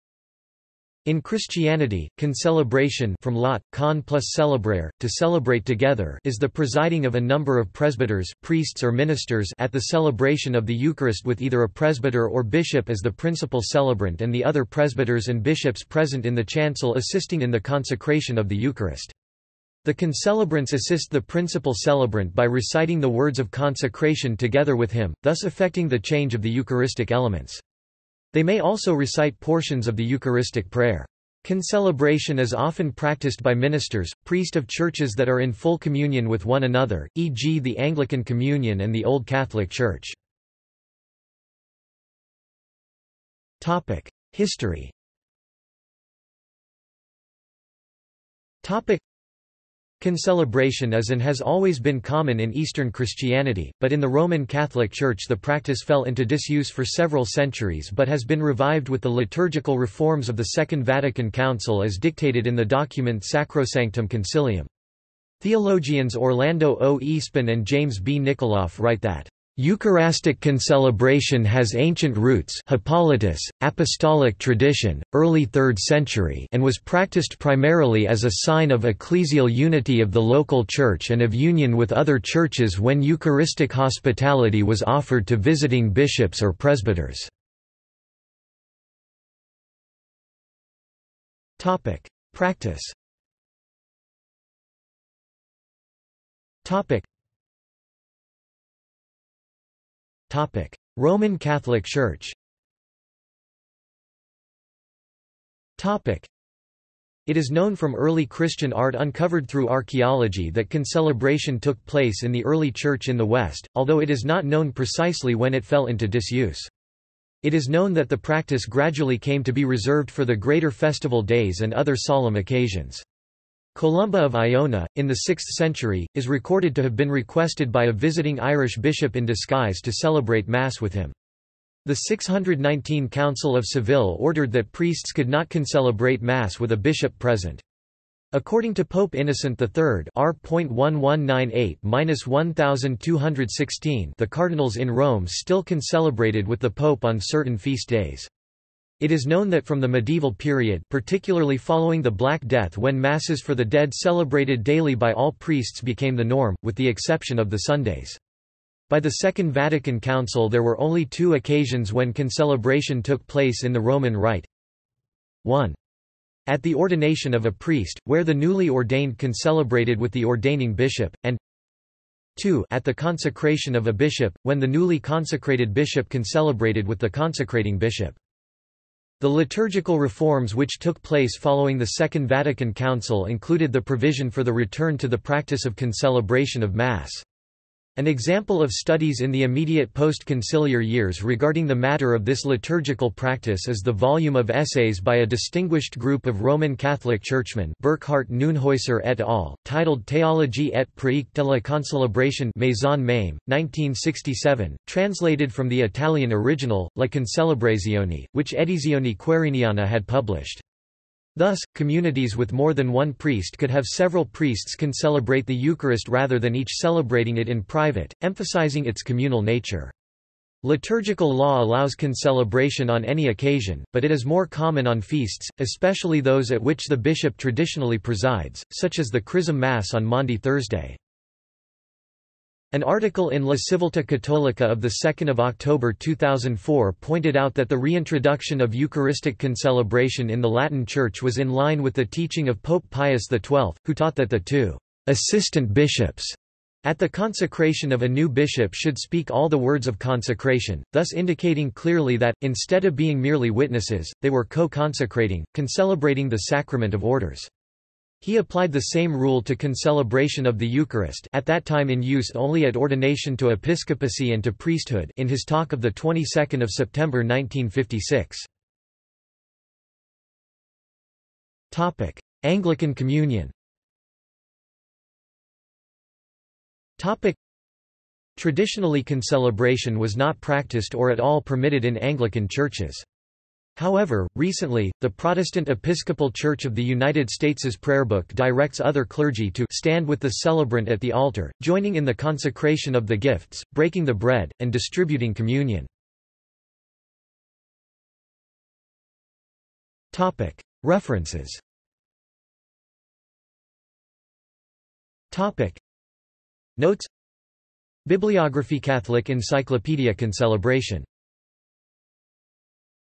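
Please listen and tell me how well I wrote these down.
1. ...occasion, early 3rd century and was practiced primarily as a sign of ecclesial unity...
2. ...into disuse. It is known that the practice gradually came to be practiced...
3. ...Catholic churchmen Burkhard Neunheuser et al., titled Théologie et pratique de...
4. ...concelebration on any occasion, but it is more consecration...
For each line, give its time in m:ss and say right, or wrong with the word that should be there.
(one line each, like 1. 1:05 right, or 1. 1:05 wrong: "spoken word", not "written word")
1. 1:14 wrong: "tradition", not "occasion"
2. 1:55 wrong: "reserved", not "practiced"
3. 3:16 right
4. 3:41 wrong: "common", not "consecration".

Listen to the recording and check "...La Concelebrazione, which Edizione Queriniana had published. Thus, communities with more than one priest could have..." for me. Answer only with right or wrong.
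right.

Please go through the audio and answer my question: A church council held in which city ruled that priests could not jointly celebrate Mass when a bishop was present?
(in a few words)
Seville.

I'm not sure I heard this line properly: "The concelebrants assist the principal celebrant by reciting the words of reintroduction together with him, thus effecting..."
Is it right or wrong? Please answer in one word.
wrong.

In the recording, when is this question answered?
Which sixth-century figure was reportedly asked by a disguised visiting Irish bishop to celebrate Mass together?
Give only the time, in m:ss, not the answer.
2:03.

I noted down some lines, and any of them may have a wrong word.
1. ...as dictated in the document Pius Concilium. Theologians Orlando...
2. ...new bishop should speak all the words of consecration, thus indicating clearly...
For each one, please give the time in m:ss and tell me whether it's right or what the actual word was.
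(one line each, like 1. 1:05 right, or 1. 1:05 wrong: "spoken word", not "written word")
1. 1:01 wrong: "Sacrosanctum", not "Pius"
2. 4:08 right.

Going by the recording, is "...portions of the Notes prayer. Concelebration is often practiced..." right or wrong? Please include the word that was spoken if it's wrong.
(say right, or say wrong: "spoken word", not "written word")
wrong: "Eucharistic", not "Notes".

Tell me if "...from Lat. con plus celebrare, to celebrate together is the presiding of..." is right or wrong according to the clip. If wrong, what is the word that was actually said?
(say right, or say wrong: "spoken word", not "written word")
right.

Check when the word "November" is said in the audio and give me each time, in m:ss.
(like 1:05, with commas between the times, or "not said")
not said.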